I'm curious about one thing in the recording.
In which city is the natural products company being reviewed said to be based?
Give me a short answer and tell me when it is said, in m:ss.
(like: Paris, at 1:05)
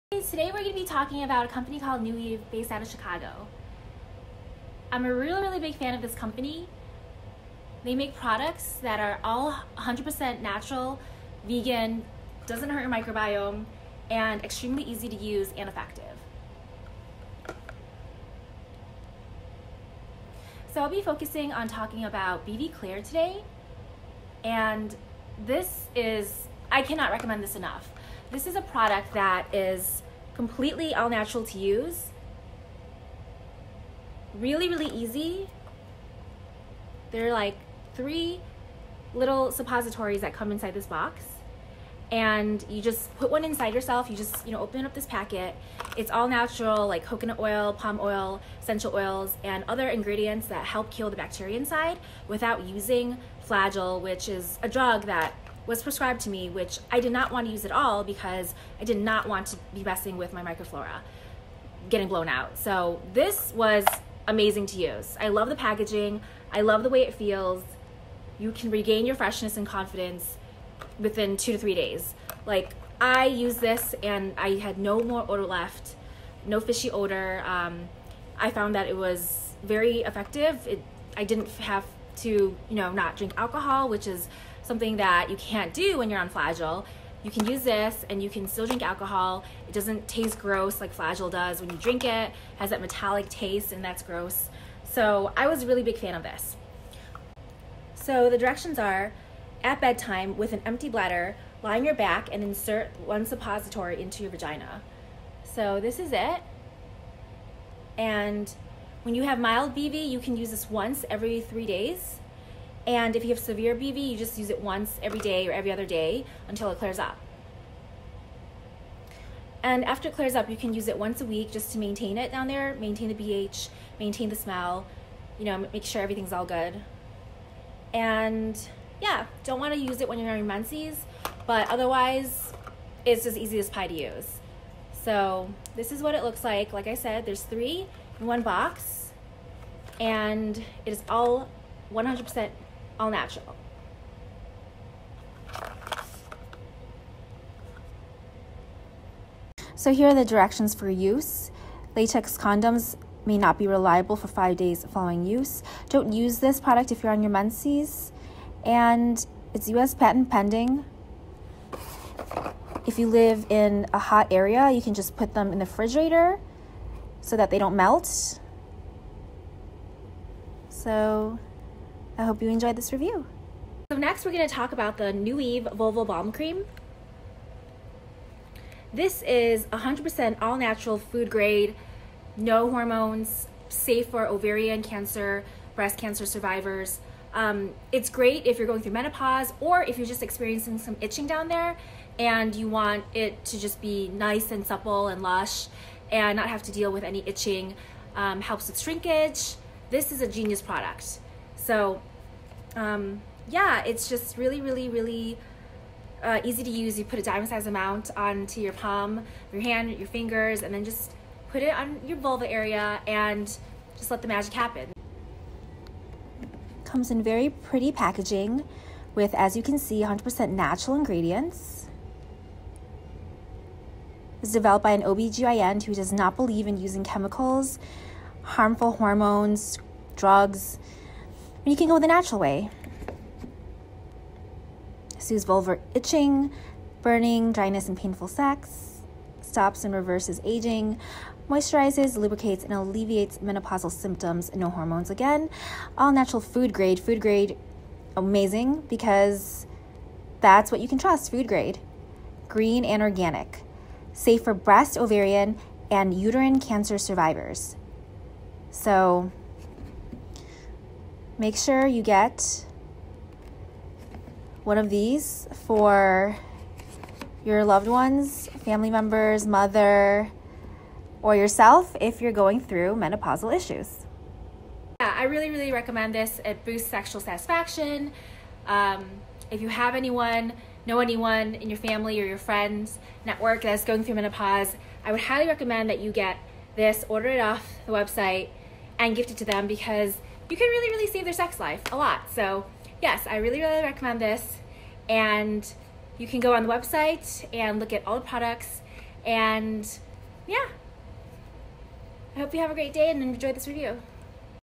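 Chicago, at 0:02.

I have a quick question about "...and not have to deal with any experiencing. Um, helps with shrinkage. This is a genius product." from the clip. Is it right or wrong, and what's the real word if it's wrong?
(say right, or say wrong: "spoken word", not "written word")
wrong: "itching", not "experiencing".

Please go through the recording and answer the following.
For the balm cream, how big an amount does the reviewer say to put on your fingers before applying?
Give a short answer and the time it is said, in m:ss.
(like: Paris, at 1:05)
Dime size, at 3:27.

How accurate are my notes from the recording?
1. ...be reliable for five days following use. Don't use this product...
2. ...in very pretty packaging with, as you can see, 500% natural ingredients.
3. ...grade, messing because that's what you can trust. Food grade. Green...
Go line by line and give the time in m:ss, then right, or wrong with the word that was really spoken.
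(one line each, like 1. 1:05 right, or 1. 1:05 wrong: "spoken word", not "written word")
1. 2:33 right
2. 3:37 wrong: "100", not "500"
3. 4:07 wrong: "amazing", not "messing".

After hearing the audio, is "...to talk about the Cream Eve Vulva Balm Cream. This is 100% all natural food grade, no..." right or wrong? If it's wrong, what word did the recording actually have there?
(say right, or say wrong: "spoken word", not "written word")
wrong: "New", not "Cream".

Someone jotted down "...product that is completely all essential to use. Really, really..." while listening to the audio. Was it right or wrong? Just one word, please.
wrong.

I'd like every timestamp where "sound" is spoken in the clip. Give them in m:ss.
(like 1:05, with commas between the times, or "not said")
not said.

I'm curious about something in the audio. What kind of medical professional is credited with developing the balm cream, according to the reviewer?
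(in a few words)
OBGYN.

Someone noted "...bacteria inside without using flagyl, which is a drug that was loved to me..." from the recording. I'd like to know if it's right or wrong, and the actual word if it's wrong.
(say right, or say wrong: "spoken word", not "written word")
wrong: "prescribed", not "loved".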